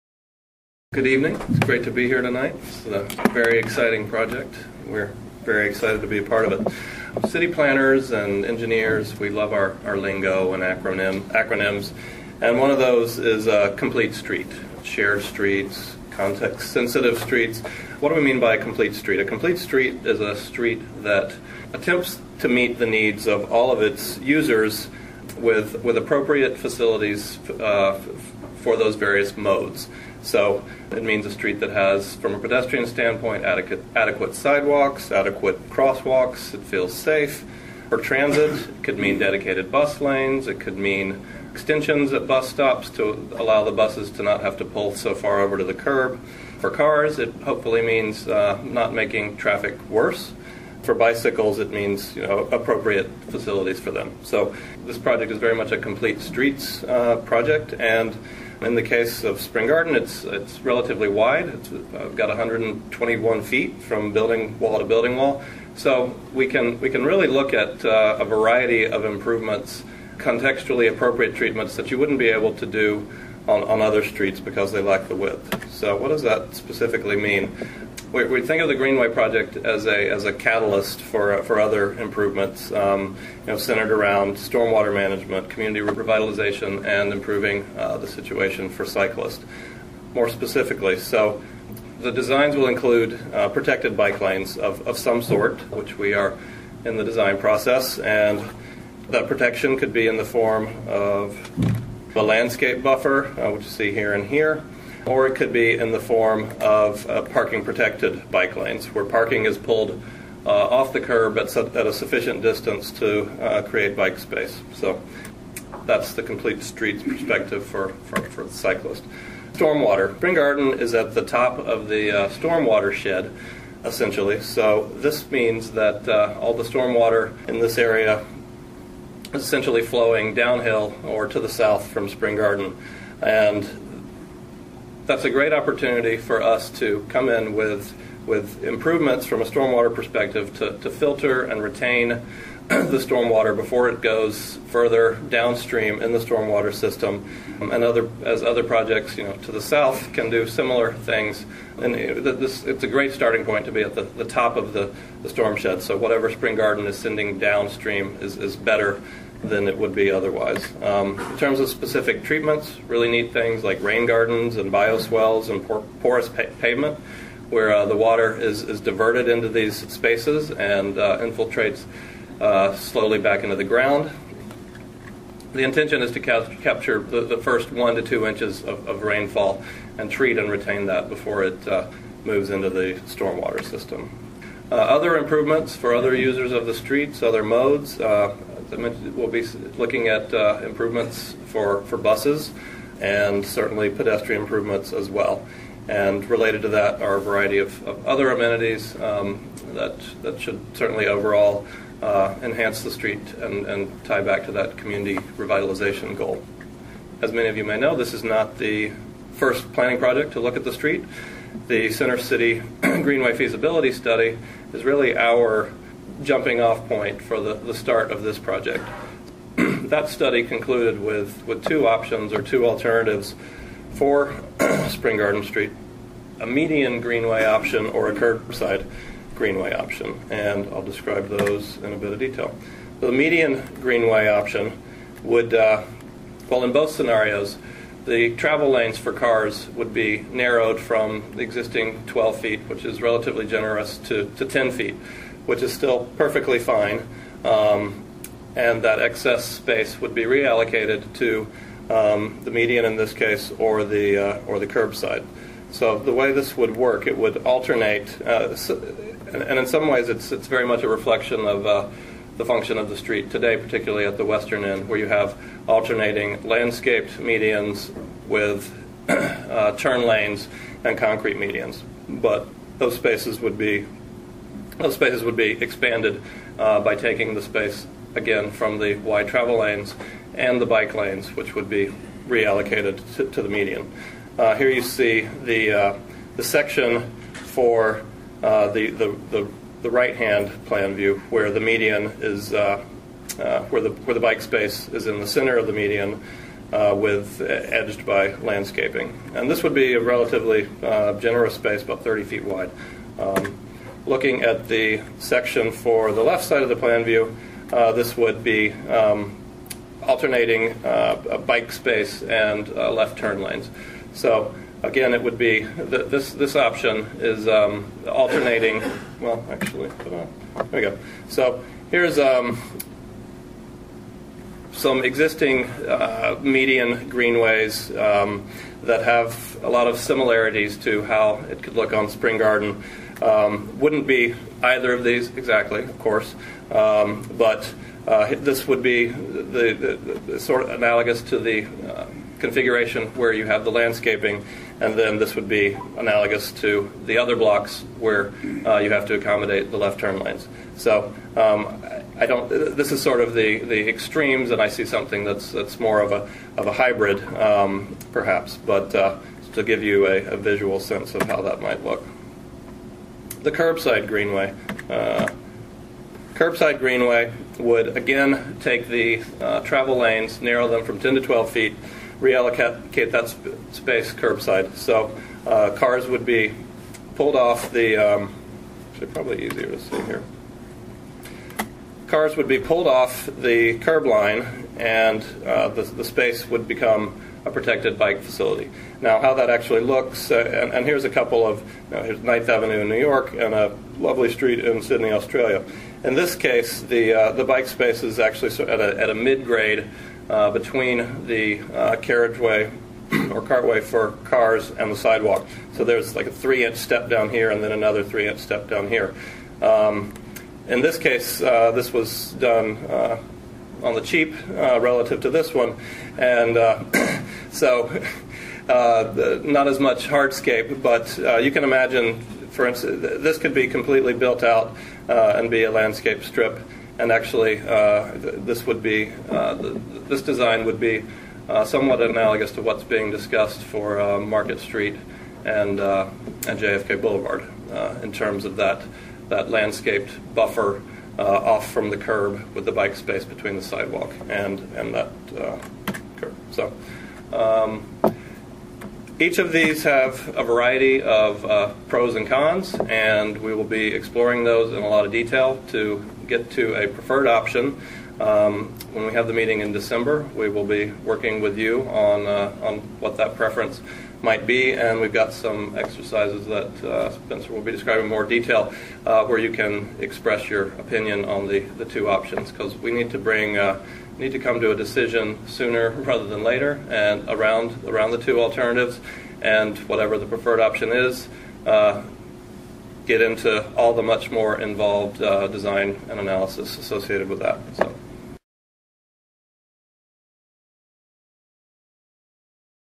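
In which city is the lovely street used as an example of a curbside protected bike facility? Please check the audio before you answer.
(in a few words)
Sydney, Australia.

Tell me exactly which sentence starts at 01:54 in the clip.
So that's the complete streets perspective for, for, for the cyclist.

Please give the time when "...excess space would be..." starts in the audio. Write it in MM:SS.
04:08.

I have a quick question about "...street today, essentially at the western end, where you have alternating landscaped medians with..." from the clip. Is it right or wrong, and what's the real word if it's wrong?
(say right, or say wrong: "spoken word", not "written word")
wrong: "particularly", not "essentially".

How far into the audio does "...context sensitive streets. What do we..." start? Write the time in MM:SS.
00:16.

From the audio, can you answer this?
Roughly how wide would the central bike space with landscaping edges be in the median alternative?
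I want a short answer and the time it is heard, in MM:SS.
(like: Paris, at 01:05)
about 30 feet, at 05:01.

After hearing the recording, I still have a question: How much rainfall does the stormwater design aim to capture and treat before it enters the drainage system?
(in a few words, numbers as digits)
first 1 to 2 inches.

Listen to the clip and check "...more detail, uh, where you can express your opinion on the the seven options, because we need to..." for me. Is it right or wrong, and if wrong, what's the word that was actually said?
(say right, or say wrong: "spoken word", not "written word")
wrong: "two", not "seven".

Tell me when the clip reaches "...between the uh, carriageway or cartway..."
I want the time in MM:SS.
06:40.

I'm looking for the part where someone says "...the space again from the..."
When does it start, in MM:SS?
04:37.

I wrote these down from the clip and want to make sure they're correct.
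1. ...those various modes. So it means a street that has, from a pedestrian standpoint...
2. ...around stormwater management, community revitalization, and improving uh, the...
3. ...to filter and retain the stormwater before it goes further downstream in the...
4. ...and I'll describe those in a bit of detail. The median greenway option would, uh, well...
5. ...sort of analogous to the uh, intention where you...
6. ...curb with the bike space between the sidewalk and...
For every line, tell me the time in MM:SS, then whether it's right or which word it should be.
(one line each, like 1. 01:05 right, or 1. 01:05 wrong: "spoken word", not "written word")
1. 00:28 right
2. 01:23 right
3. 02:20 right
4. 03:50 right
5. 05:40 wrong: "configuration", not "intention"
6. 07:21 right.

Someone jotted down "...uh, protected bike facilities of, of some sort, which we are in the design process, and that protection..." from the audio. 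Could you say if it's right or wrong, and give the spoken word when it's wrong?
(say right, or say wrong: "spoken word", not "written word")
wrong: "lanes", not "facilities".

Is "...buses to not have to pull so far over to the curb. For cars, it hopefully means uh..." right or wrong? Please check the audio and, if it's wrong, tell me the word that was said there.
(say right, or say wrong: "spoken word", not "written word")
right.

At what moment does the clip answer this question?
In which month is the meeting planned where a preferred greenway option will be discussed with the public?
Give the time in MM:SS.
07:39.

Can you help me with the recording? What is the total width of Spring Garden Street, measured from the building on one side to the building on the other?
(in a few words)
121 feet.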